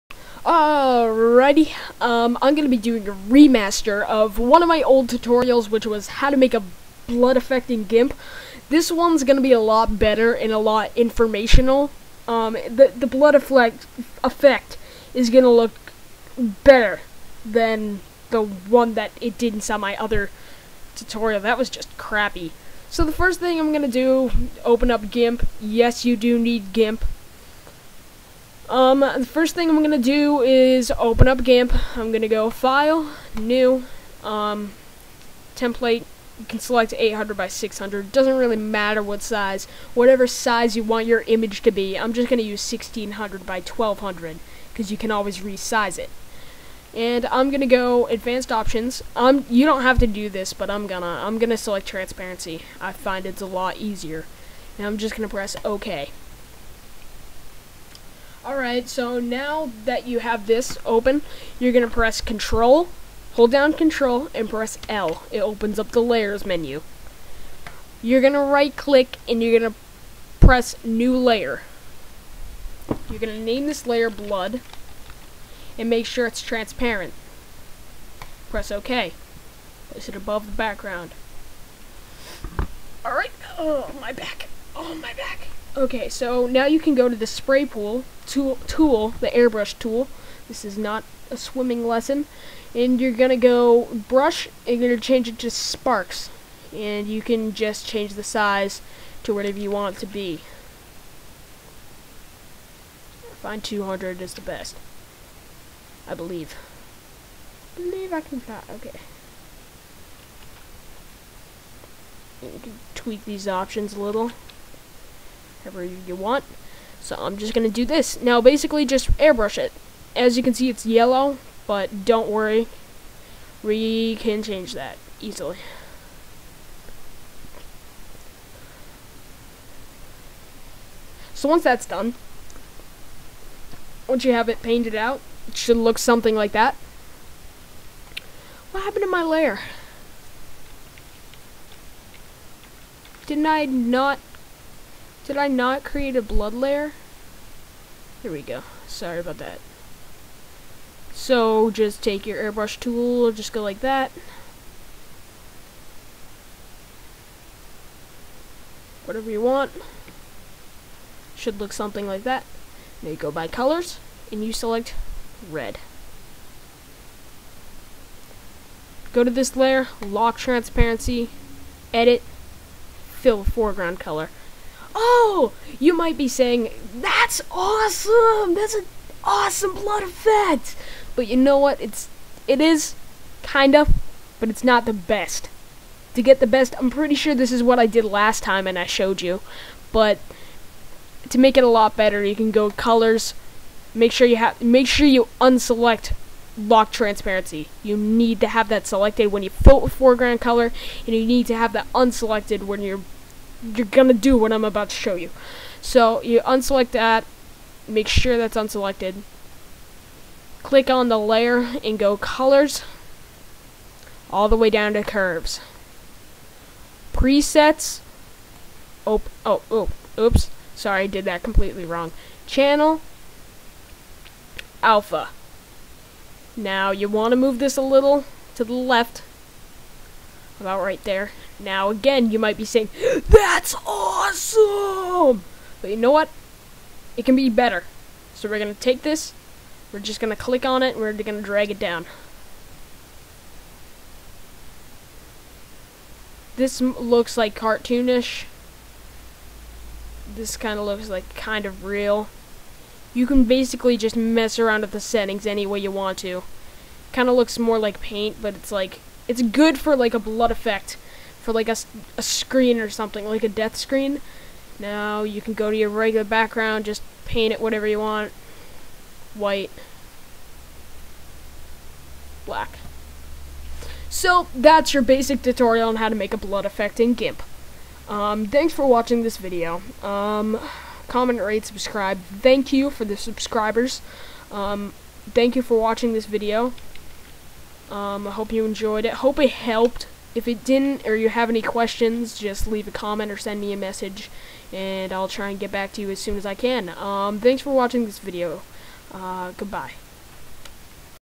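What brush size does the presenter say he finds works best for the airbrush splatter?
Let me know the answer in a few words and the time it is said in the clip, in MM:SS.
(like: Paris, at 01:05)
200, at 01:43.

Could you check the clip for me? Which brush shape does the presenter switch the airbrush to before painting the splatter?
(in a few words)
Sparks.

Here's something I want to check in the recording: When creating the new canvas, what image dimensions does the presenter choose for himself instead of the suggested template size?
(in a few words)
1600 by 1200.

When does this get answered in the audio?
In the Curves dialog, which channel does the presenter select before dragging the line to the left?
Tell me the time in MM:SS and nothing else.
03:44.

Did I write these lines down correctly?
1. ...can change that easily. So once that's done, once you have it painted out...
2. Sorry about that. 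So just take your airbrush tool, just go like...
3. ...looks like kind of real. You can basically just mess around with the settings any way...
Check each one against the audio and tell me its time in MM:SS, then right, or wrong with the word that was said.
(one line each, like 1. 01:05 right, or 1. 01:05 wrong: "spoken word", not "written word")
1. 02:04 right
2. 02:28 right
3. 04:10 right.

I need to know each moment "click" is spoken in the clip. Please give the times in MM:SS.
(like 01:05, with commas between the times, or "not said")
01:08, 03:30, 04:00.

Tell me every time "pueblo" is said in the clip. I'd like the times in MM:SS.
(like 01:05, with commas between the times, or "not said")
not said.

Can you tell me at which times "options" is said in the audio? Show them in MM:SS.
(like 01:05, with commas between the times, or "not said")
00:48, 01:53.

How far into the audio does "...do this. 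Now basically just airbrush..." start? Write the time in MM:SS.
01:57.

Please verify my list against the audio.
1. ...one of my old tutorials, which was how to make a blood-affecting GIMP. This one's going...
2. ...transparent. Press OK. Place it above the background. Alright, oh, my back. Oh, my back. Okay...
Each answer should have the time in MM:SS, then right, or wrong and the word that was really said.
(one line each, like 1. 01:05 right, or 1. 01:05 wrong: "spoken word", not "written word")
1. 00:04 right
2. 01:16 right.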